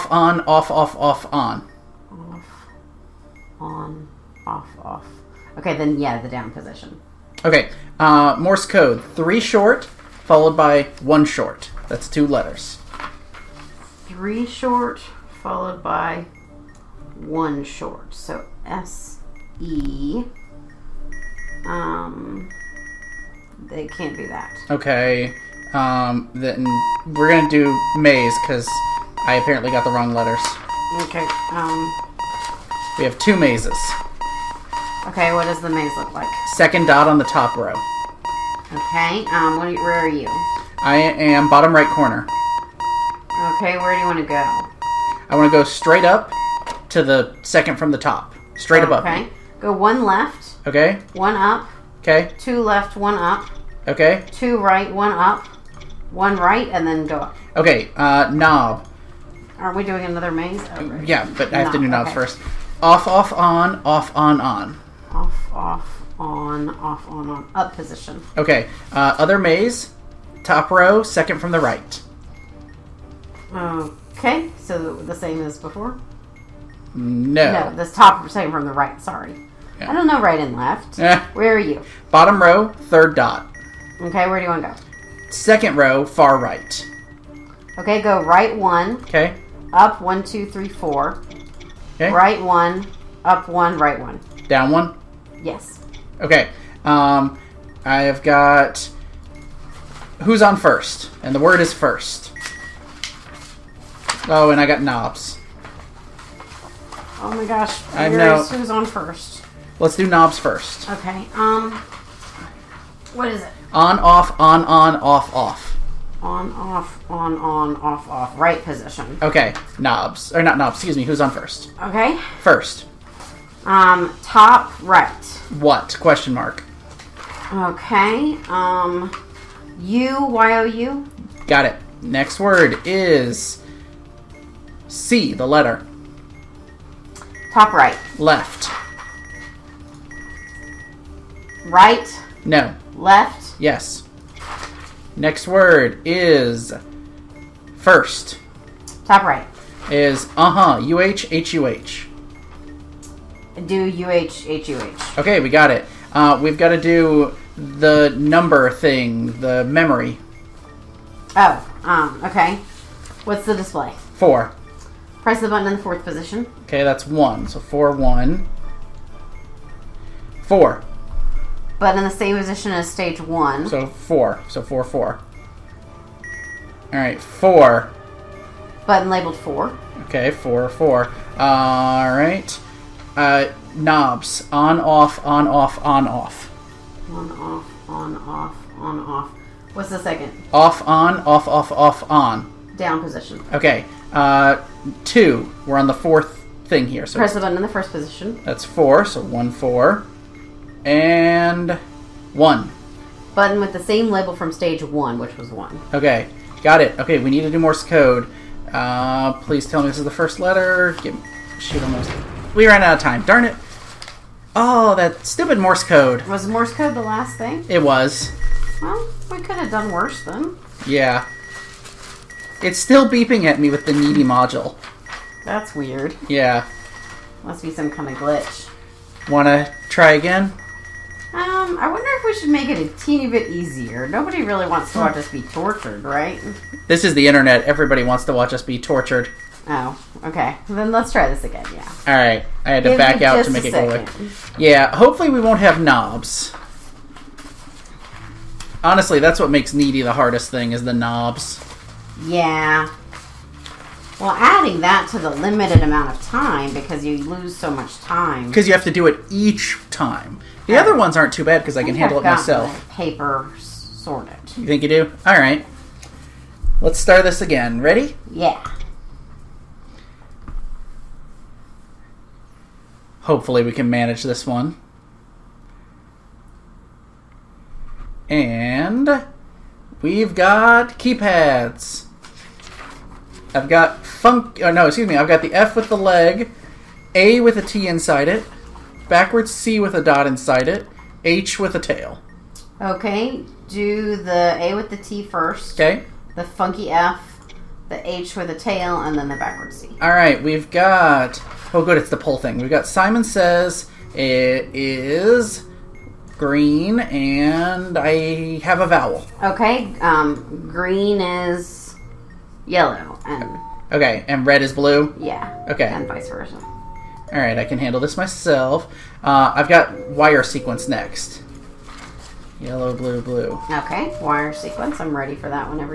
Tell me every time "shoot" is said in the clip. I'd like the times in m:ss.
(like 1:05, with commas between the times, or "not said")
3:31.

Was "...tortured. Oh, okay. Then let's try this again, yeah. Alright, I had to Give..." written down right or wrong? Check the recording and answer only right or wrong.
right.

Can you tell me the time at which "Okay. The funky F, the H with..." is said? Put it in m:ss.
4:55.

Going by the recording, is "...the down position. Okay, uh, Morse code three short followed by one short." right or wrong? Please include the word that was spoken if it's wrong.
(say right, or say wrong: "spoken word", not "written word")
right.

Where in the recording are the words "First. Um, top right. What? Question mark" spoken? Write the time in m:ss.
2:02.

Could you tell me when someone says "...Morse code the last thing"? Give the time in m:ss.
3:36.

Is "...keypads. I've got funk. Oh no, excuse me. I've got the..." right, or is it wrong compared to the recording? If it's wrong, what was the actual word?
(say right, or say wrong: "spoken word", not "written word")
right.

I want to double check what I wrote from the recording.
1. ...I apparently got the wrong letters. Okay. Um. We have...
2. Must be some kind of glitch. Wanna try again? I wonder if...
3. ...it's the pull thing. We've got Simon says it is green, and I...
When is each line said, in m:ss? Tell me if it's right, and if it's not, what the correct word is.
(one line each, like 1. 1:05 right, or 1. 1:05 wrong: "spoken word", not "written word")
1. 0:29 right
2. 3:47 right
3. 5:01 right.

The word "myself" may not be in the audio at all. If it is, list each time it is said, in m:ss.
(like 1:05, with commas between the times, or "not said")
4:22, 5:18.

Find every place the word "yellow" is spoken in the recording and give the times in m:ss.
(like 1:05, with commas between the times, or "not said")
5:12, 5:22.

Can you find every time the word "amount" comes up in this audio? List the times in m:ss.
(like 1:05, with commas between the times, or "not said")
4:15.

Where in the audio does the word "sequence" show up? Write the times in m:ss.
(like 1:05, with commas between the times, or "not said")
5:20, 5:24.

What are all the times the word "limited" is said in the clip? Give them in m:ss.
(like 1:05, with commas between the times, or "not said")
4:15.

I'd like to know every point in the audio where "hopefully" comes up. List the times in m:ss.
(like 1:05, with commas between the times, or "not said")
4:04, 4:33.